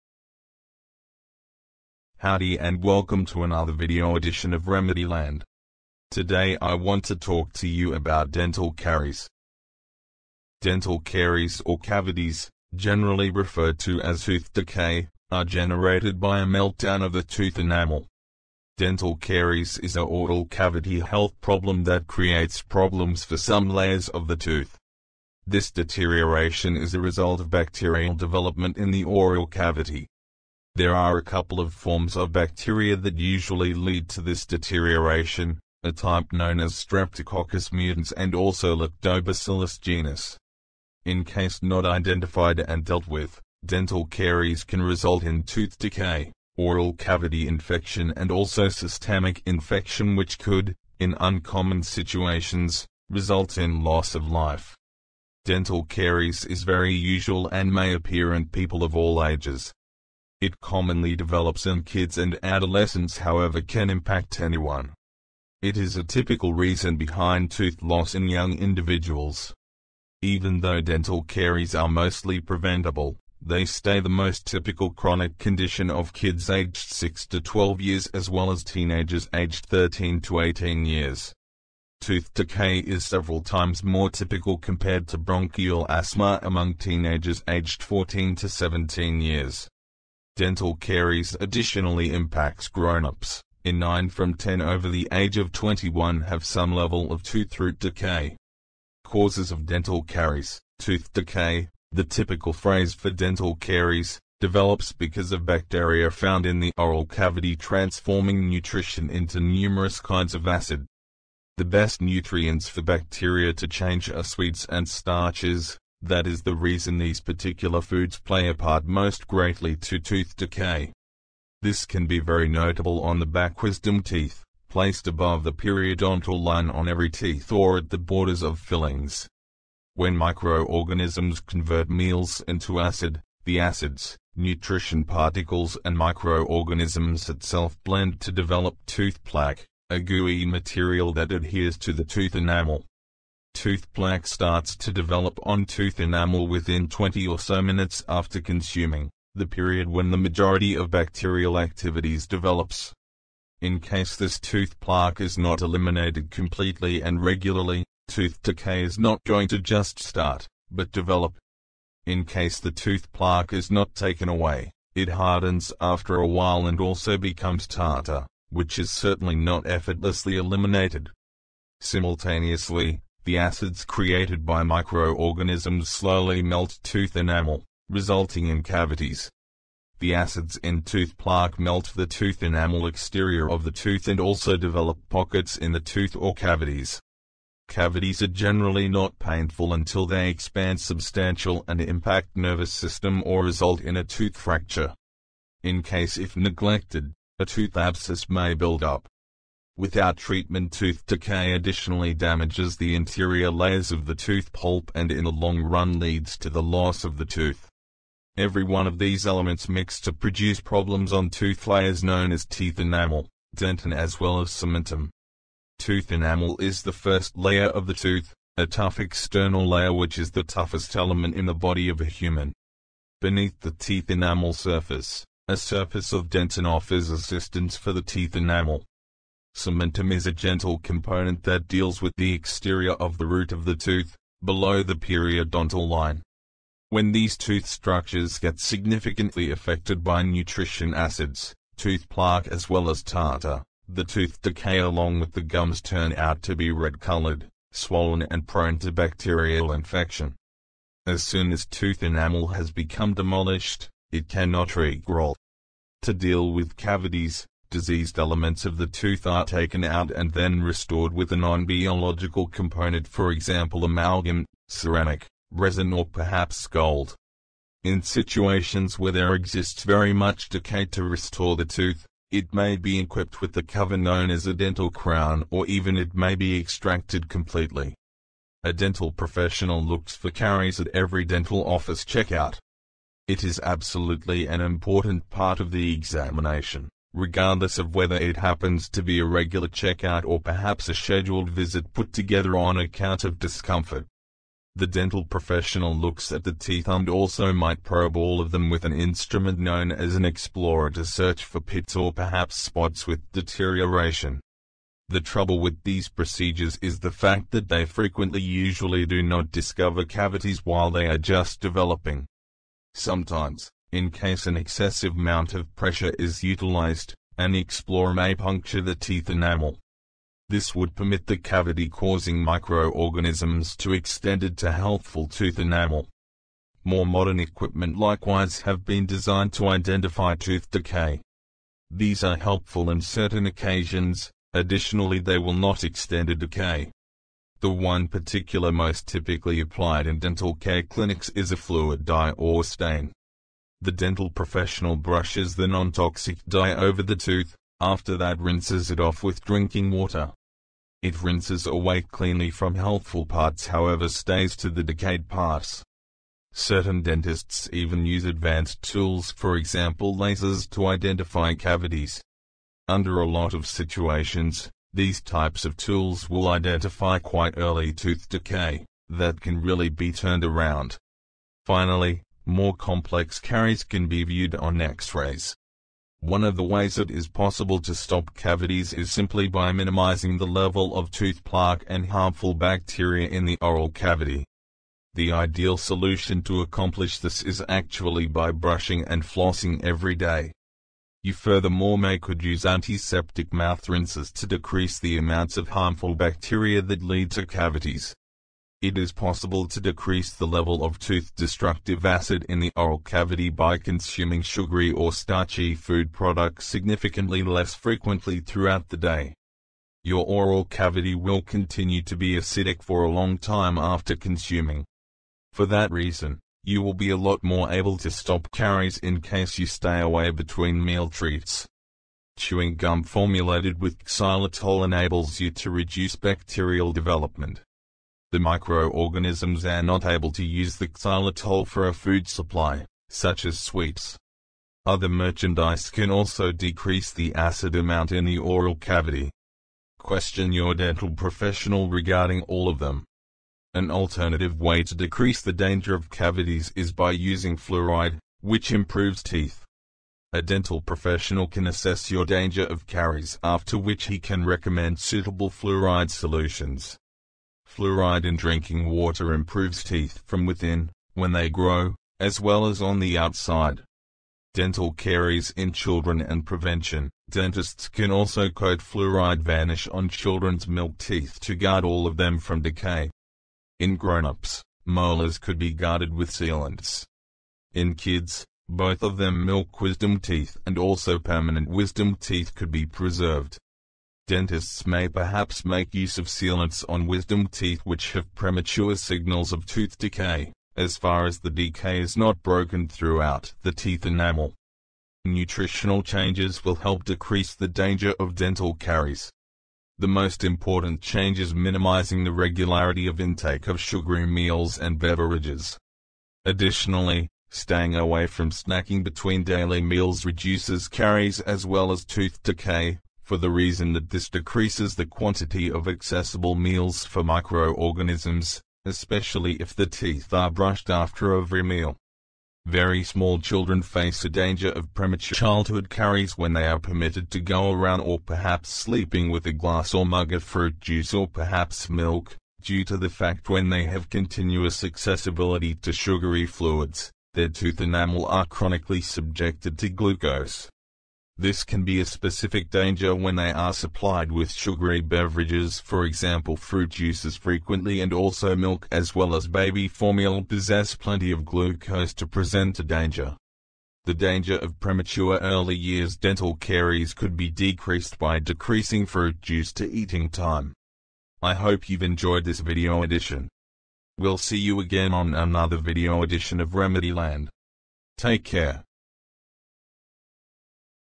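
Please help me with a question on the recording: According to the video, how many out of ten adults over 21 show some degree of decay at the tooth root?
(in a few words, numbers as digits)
9.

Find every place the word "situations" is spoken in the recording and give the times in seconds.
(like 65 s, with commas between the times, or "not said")
51 s, 268 s, 363 s.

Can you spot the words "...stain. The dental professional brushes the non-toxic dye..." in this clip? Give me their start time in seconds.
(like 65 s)
342 s.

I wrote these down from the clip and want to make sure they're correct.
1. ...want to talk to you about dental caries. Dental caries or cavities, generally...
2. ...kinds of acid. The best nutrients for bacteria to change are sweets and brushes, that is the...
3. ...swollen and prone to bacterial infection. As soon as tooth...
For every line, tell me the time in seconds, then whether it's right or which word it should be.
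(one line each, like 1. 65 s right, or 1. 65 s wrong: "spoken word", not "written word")
1. 6 s right
2. 109 s wrong: "starches", not "brushes"
3. 247 s right.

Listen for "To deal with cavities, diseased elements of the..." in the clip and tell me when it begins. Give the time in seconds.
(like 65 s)
256 s.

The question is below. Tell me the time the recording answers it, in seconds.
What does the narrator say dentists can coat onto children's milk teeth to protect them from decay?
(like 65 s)
468 s.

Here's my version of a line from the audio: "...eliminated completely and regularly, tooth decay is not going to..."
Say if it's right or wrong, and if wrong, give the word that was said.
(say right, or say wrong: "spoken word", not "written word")
right.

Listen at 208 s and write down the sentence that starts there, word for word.
Every one of these elements mix to produce problems on tooth layers known as teeth enamel, dentin as well as cementum.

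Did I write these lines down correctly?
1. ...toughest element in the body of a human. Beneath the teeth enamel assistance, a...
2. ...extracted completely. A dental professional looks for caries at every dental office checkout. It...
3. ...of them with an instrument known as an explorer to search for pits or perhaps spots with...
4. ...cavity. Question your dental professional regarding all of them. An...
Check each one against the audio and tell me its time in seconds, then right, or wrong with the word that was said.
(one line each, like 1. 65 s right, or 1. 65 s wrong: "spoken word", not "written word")
1. 220 s wrong: "surface", not "assistance"
2. 276 s right
3. 298 s right
4. 438 s right.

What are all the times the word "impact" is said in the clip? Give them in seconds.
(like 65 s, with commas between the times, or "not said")
63 s, 92 s, 191 s.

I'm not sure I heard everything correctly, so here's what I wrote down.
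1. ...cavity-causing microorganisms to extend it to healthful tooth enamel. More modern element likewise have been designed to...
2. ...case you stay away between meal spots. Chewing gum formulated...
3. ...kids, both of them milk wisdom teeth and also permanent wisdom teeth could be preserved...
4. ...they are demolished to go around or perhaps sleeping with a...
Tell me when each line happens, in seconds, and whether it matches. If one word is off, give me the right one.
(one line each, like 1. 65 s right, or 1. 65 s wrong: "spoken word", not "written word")
1. 321 s wrong: "equipment", not "element"
2. 419 s wrong: "treats", not "spots"
3. 477 s right
4. 526 s wrong: "permitted", not "demolished".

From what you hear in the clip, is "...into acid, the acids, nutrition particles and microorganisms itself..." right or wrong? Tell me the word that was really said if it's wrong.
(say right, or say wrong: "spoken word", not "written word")
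right.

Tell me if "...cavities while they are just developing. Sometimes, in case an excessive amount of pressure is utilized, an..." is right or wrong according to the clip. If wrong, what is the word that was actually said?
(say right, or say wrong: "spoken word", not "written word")
right.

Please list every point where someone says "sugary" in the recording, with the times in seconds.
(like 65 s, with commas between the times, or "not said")
404 s, 503 s, 535 s, 544 s.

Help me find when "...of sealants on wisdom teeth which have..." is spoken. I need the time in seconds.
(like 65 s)
486 s.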